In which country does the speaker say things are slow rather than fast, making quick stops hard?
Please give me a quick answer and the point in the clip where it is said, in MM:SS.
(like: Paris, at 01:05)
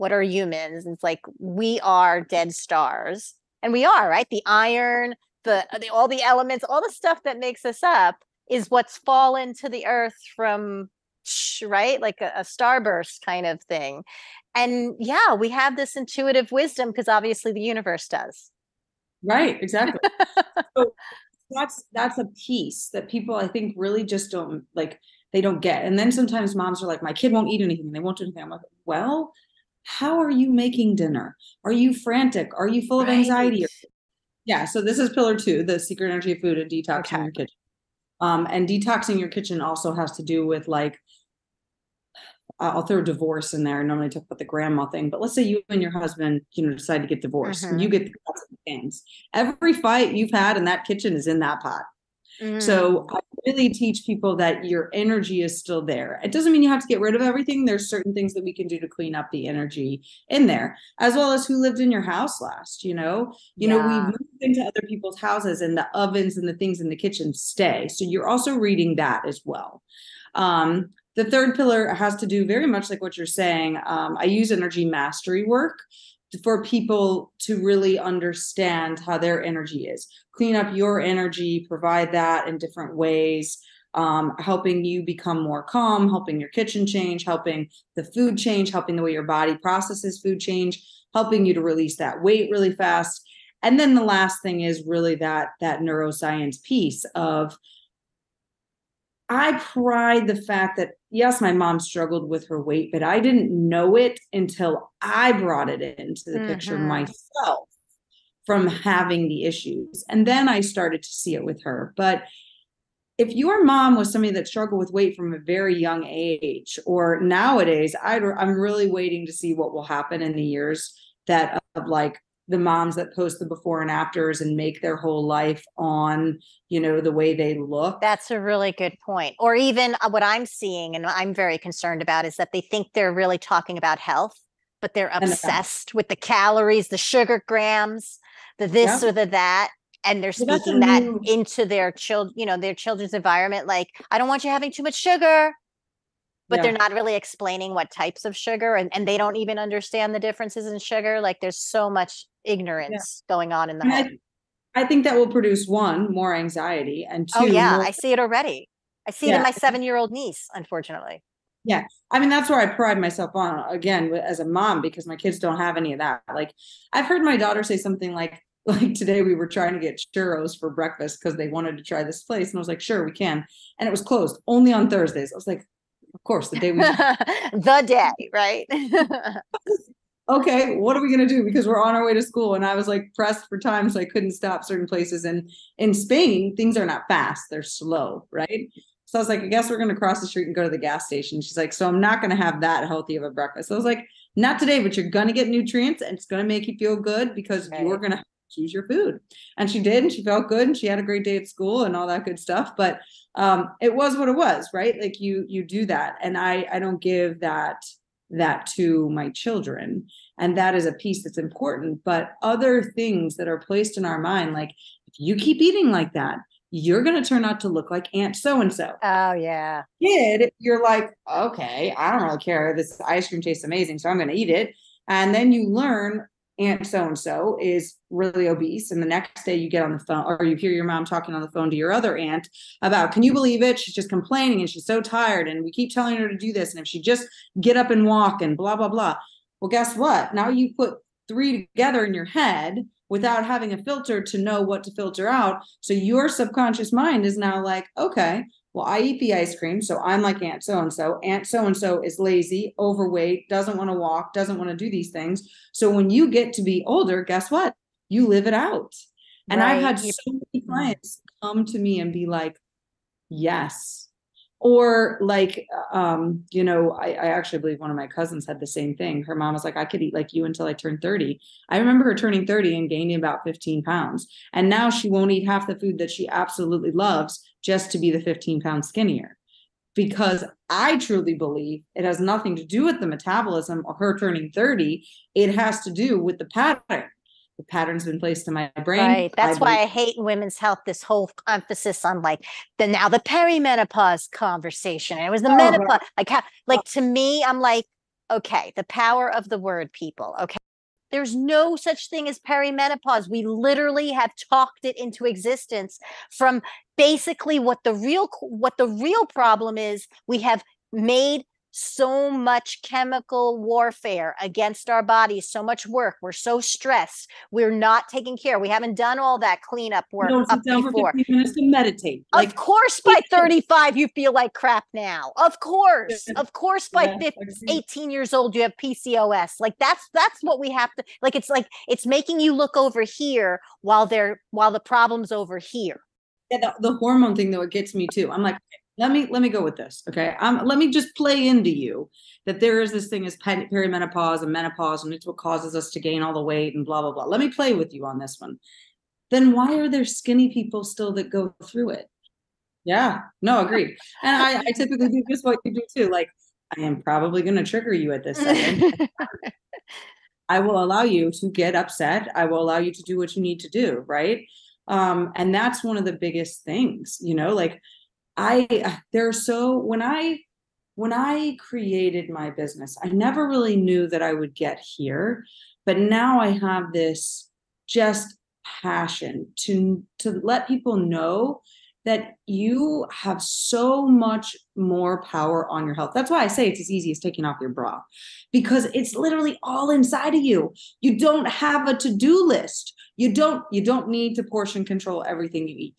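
Spain, at 03:05.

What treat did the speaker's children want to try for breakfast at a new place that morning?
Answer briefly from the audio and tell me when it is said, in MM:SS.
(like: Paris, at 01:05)
Churros, at 02:50.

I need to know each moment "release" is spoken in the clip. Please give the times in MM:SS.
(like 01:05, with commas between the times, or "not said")
01:31.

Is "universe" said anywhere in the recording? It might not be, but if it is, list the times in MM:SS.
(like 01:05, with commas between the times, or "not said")
00:17.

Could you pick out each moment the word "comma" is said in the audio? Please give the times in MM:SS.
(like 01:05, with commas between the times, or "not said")
not said.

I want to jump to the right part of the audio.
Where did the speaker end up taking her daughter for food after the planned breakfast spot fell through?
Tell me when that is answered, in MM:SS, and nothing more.
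03:10.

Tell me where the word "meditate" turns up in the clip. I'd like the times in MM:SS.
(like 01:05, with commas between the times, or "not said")
05:21.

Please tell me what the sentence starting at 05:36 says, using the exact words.
Yeah, the, the hormone thing though, it gets me too.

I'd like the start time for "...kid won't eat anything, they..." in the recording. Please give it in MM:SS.
00:27.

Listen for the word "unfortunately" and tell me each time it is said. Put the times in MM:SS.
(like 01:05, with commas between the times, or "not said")
02:40.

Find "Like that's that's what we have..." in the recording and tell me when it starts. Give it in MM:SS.
05:29.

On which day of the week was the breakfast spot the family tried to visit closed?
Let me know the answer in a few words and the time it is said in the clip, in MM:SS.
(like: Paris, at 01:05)
Thursdays, at 02:54.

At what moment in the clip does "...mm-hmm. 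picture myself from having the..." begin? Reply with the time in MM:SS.
01:46.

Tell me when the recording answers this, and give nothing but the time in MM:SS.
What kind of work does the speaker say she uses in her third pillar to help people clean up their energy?
01:14.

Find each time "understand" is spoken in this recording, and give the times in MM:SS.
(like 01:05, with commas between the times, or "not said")
01:17, 02:29.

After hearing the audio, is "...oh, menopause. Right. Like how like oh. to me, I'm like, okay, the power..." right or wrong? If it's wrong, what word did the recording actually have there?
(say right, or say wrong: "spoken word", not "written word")
right.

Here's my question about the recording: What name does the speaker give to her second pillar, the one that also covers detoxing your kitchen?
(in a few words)
The secret energy of food.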